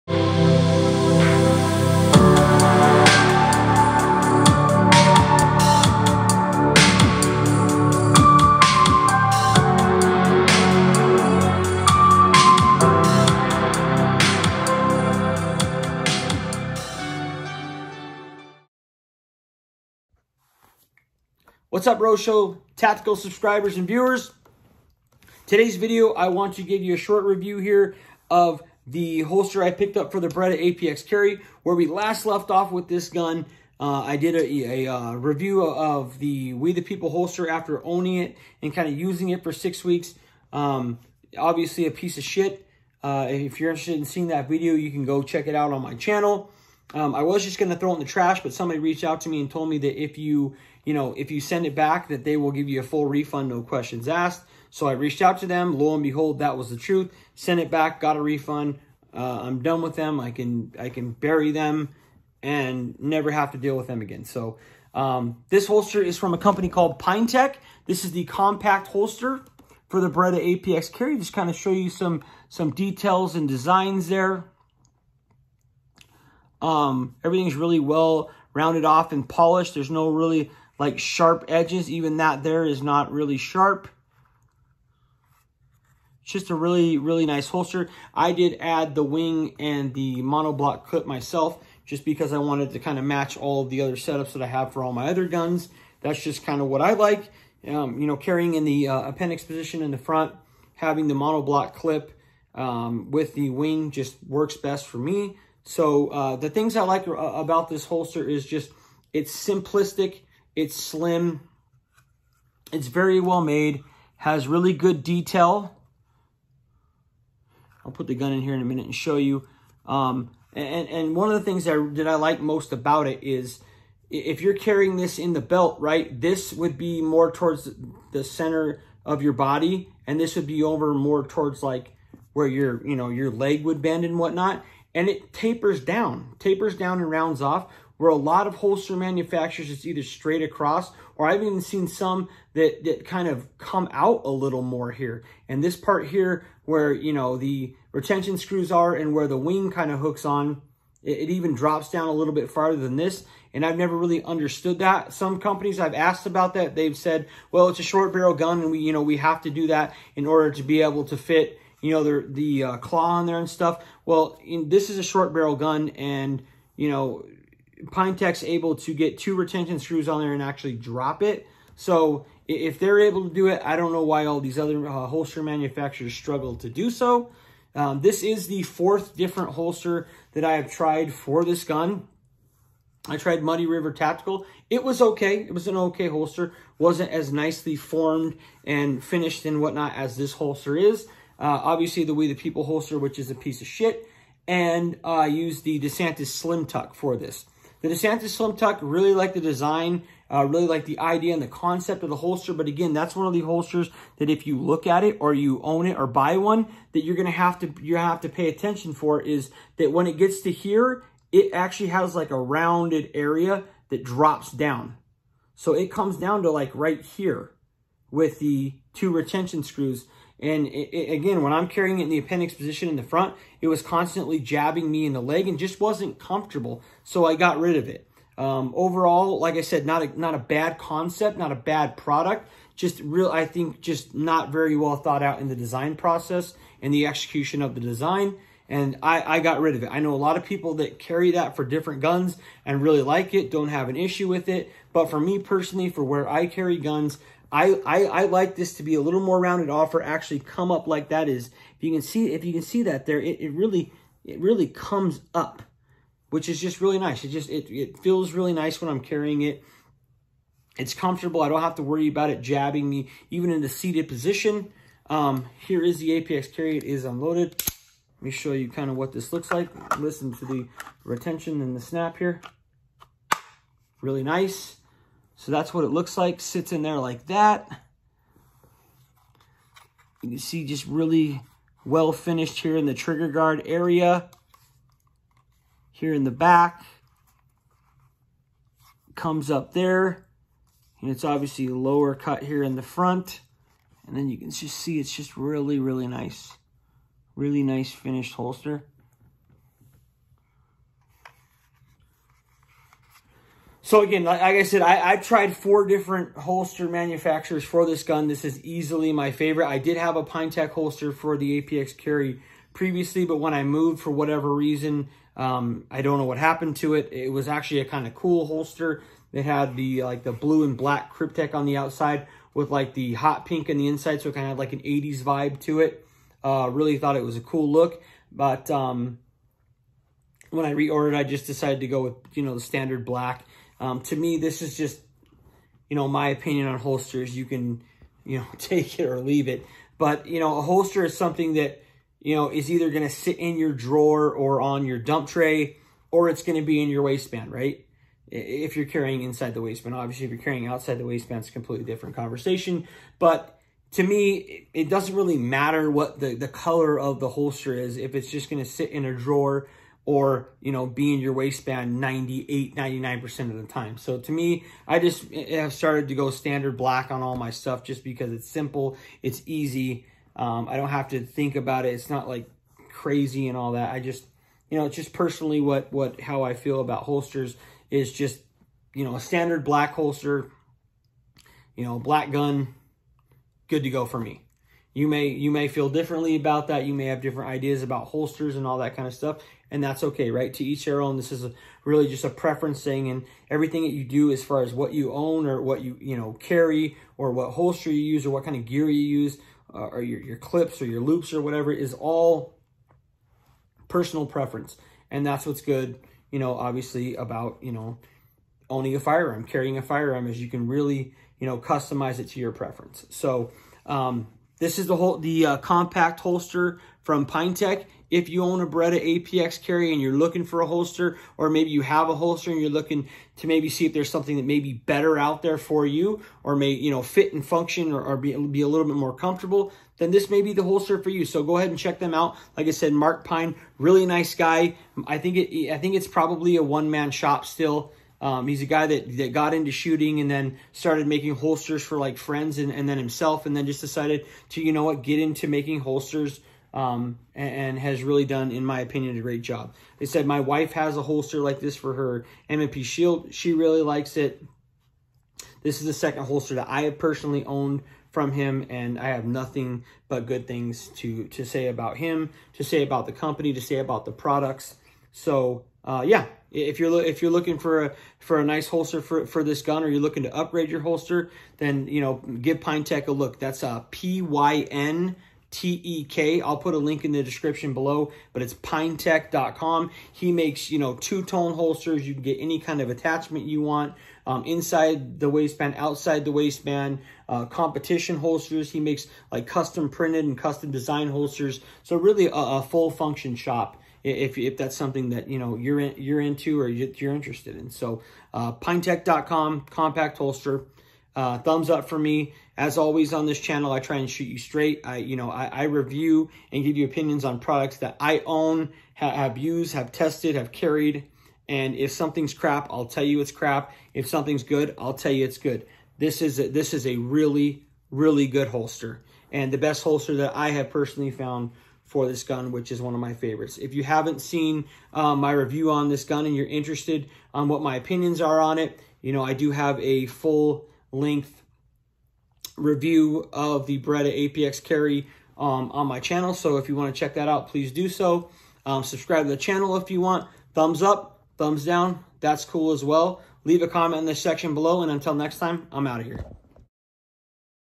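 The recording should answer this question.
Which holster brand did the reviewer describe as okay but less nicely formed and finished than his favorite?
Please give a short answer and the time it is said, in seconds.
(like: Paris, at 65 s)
Muddy River Tactical, at 183 s.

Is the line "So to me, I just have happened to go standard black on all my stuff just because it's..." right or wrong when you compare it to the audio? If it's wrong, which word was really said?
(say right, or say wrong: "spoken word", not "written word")
wrong: "started", not "happened".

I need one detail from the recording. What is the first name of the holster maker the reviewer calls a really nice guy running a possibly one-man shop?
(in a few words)
Mark.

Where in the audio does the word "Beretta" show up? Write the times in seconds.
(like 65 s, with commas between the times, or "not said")
30 s, 70 s, 418 s, 533 s.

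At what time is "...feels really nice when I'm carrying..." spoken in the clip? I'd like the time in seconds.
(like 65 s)
257 s.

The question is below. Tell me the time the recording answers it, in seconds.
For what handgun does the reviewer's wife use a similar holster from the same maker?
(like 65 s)
452 s.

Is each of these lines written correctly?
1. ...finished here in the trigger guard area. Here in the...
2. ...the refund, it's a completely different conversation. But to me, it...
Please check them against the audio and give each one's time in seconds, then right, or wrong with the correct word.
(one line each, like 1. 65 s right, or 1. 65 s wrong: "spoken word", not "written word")
1. 282 s right
2. 350 s wrong: "waistband", not "refund".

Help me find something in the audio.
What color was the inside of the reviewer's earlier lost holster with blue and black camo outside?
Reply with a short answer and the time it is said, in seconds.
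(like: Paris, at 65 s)
Hot pink, at 323 s.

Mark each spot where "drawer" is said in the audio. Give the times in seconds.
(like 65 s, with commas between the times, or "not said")
343 s, 359 s.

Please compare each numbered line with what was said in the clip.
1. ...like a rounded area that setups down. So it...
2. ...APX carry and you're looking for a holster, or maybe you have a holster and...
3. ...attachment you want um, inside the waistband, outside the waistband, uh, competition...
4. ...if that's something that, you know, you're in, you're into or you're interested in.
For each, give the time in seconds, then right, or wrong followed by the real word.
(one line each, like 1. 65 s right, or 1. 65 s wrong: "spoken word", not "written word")
1. 212 s wrong: "drops", not "setups"
2. 419 s right
3. 482 s right
4. 494 s right.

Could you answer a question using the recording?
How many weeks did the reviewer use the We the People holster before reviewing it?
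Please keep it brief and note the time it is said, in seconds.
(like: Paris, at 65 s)
6, at 39 s.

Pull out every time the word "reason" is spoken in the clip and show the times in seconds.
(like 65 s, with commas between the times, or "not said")
314 s.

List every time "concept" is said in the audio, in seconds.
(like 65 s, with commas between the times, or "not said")
201 s, 230 s.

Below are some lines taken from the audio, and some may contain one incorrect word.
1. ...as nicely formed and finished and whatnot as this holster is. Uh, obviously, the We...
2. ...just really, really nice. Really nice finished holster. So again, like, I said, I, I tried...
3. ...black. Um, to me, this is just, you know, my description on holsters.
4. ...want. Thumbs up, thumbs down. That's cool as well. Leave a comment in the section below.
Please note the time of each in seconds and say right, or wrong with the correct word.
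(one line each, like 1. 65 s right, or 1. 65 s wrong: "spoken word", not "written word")
1. 187 s right
2. 295 s right
3. 333 s wrong: "opinion", not "description"
4. 539 s right.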